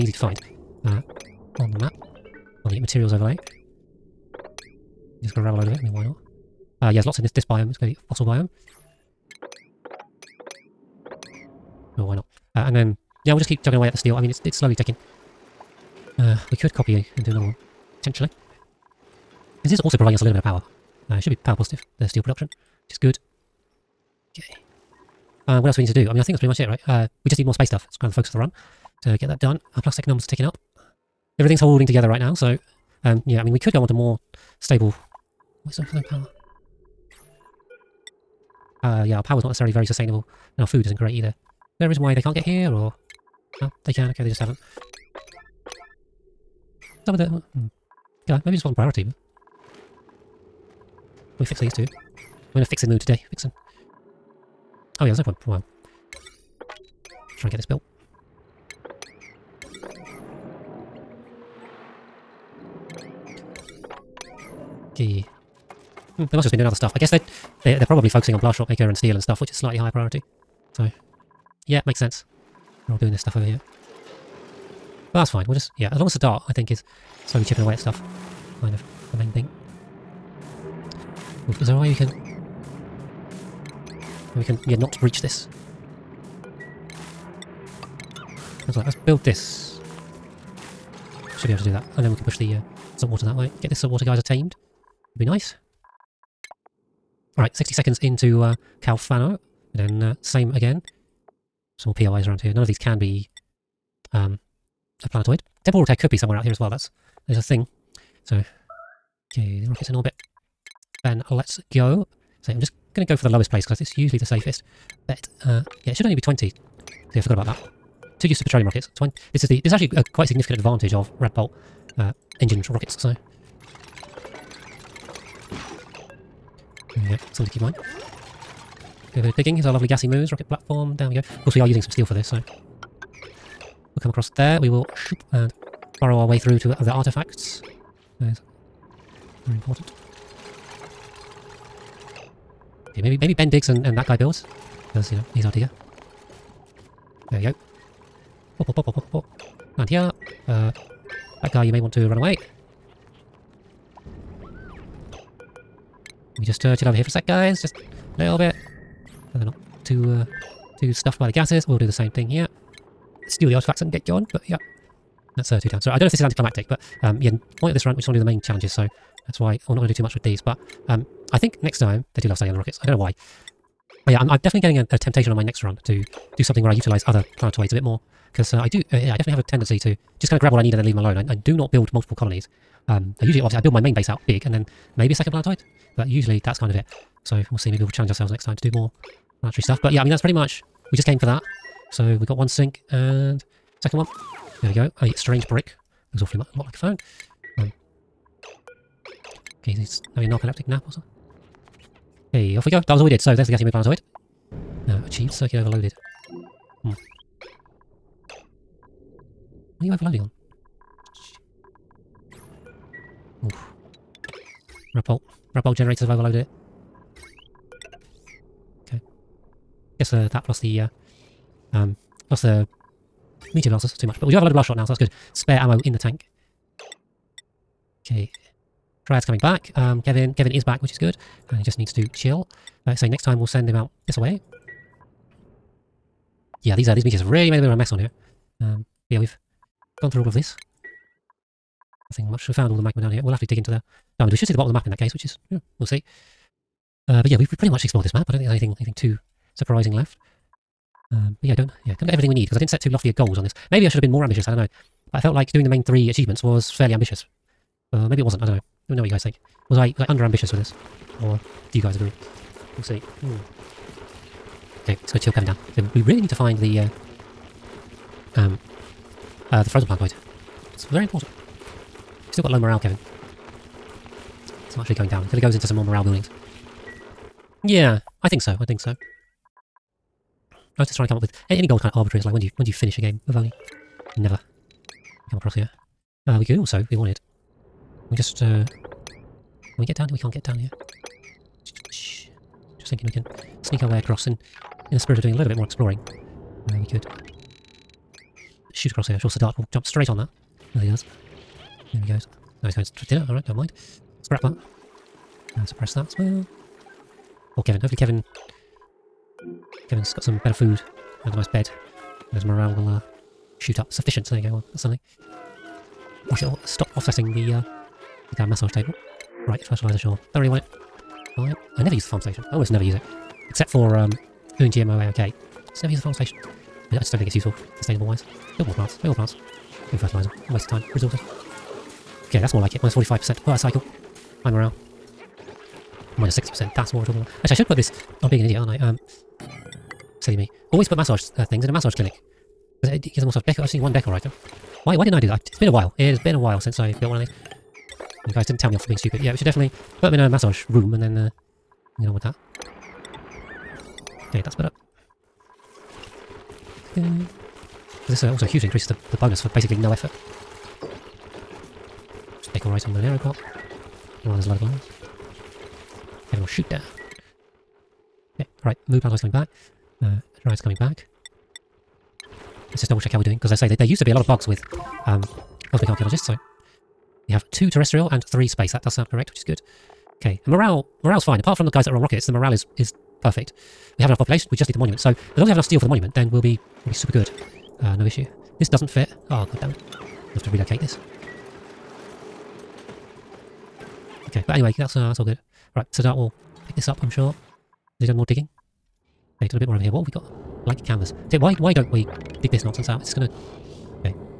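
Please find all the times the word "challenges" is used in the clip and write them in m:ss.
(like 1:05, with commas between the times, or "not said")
2:48, 3:07.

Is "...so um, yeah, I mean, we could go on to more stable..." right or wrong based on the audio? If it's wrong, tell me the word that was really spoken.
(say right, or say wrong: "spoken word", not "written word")
right.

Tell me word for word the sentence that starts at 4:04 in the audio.
We should see the bottom of the map in that case, which is, yeah, we'll see.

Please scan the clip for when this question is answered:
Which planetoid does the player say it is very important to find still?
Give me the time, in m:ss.
4:29.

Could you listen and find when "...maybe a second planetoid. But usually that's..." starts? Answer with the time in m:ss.
3:04.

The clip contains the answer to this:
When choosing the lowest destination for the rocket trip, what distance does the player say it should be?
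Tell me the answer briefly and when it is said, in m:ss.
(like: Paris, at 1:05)
20, at 1:55.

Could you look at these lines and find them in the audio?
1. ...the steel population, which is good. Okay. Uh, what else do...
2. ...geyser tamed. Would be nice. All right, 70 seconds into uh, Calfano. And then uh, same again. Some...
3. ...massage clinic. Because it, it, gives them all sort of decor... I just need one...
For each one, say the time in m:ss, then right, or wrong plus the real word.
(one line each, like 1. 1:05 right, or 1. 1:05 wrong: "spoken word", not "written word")
1. 0:21 wrong: "production", not "population"
2. 1:34 wrong: "60", not "70"
3. 5:41 right.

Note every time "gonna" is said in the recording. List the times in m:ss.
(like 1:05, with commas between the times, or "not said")
4:25, 6:43.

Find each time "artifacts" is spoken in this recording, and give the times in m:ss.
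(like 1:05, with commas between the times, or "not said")
2:16, 2:43.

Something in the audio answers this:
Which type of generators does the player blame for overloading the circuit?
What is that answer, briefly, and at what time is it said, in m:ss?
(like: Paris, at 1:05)
Radbolt generators, at 3:35.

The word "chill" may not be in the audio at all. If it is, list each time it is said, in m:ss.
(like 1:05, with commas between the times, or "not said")
2:36, 3:52, 4:25.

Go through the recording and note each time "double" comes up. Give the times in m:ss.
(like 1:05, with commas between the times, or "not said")
6:12.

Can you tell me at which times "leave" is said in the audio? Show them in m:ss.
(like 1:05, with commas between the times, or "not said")
3:00.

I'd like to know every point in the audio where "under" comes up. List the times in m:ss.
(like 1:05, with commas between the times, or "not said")
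4:20.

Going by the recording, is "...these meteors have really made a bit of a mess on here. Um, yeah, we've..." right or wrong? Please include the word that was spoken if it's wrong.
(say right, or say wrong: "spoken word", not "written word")
right.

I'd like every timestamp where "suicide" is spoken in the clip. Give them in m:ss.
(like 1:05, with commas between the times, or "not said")
not said.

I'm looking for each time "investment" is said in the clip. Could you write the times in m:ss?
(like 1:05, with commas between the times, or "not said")
not said.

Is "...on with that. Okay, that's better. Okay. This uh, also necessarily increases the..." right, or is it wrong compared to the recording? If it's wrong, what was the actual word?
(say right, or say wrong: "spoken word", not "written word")
wrong: "hugely", not "necessarily".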